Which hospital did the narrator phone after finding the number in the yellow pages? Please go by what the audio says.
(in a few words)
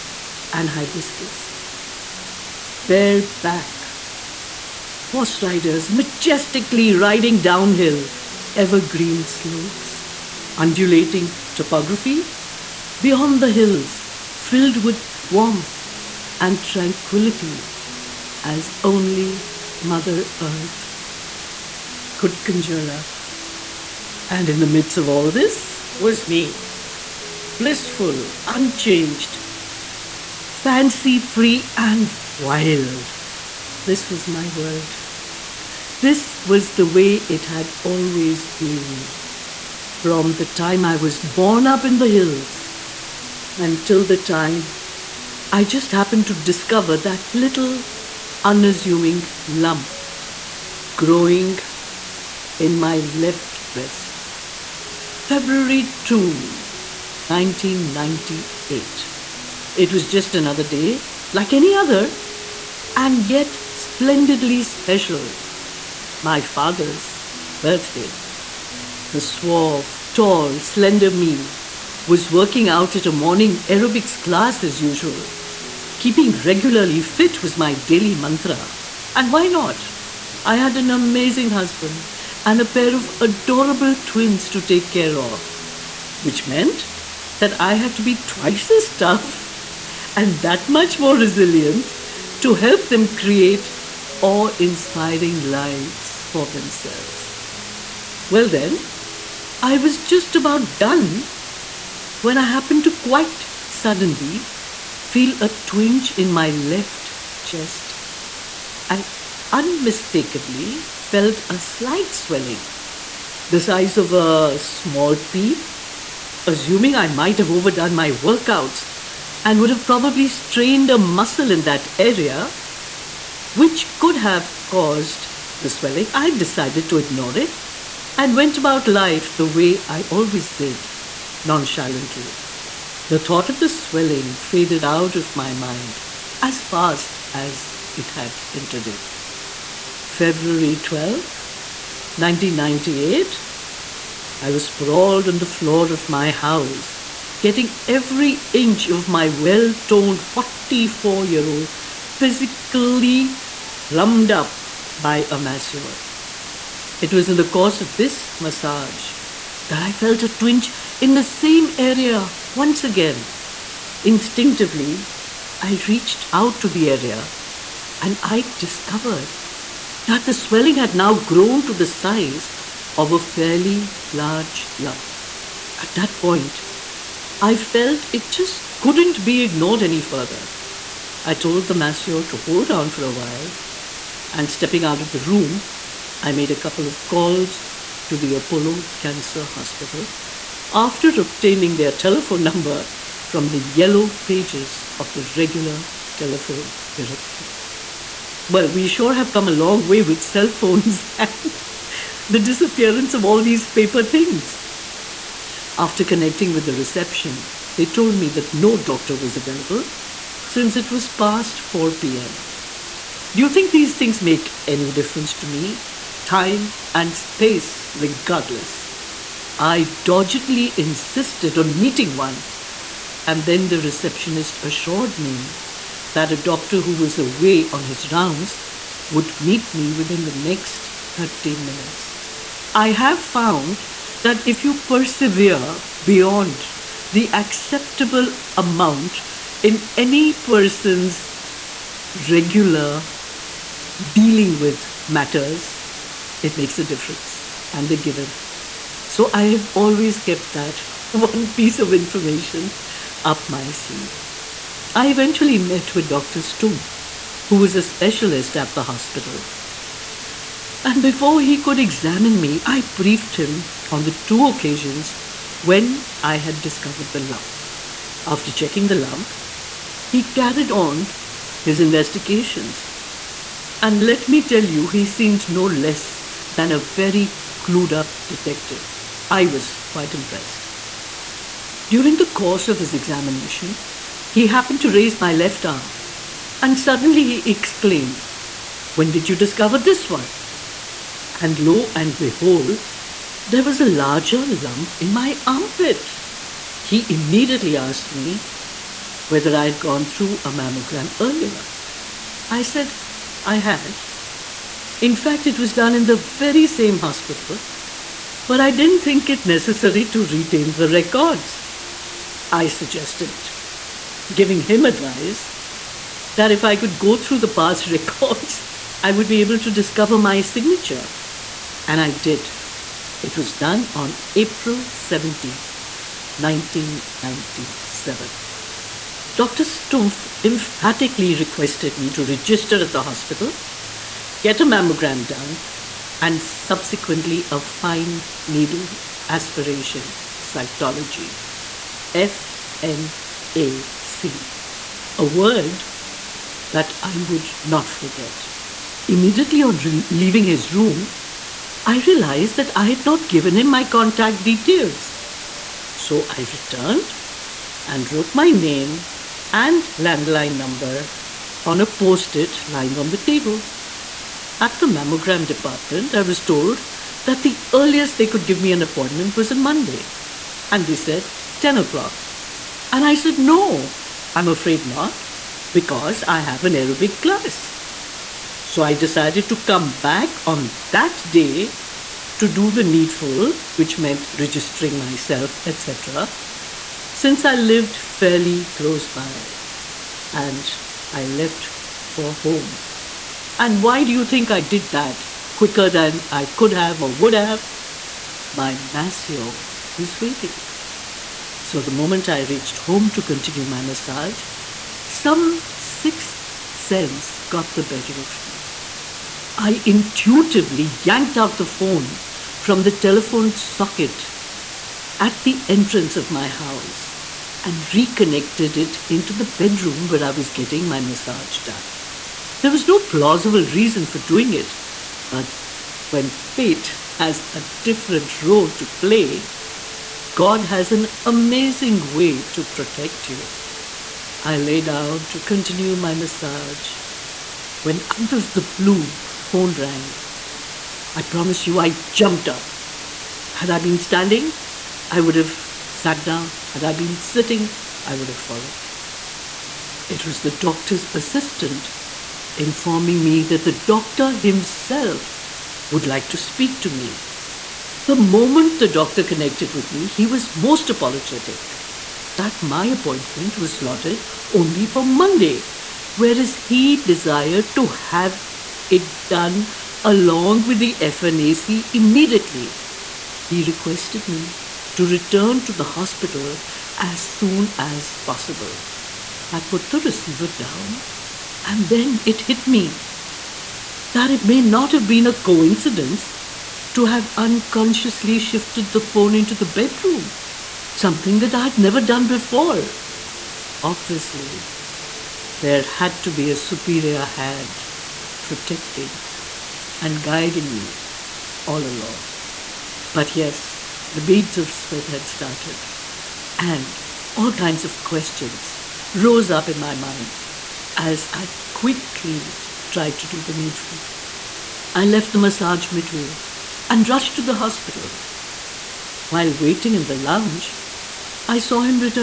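Apollo Cancer Hospital.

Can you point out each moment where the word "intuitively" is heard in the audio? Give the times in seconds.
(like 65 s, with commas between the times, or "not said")
409 s.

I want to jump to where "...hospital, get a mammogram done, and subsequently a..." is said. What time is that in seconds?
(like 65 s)
333 s.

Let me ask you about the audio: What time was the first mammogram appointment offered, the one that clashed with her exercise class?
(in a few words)
10 o'clock.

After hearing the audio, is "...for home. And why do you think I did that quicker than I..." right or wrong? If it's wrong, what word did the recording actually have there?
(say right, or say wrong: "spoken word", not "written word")
right.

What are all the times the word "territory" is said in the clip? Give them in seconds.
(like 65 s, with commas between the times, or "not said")
not said.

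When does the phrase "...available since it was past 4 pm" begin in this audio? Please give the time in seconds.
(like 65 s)
209 s.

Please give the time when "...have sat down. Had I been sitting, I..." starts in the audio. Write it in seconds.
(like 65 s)
445 s.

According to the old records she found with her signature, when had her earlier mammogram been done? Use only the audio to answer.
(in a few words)
April 17, 1997.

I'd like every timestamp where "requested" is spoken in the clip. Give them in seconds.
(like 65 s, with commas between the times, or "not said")
331 s, 473 s.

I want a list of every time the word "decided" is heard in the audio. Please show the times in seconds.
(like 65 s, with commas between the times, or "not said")
126 s, 378 s.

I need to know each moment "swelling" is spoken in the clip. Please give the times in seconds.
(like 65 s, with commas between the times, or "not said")
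112 s, 125 s, 133 s, 170 s.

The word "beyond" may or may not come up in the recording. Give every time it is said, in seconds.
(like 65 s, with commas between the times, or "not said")
12 s, 236 s.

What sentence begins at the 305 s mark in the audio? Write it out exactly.
In fact, it was done in the very same hospital, but I didn't think it necessary to retain the records.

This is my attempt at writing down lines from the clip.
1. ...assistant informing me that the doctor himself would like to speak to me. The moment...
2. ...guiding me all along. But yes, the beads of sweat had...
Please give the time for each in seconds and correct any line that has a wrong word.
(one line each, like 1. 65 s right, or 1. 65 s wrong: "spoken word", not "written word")
1. 451 s right
2. 500 s right.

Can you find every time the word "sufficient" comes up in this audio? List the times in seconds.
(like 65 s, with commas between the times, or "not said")
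not said.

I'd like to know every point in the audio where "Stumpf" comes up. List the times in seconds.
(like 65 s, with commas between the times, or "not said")
256 s, 329 s.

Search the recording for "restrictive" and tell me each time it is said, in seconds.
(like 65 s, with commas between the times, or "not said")
not said.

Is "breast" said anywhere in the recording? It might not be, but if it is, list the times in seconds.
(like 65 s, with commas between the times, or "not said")
53 s.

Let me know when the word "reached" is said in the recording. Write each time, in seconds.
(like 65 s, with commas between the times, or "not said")
165 s, 402 s.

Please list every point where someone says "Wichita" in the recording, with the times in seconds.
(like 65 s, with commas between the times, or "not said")
not said.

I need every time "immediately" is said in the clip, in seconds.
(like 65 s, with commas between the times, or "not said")
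297 s, 349 s, 471 s.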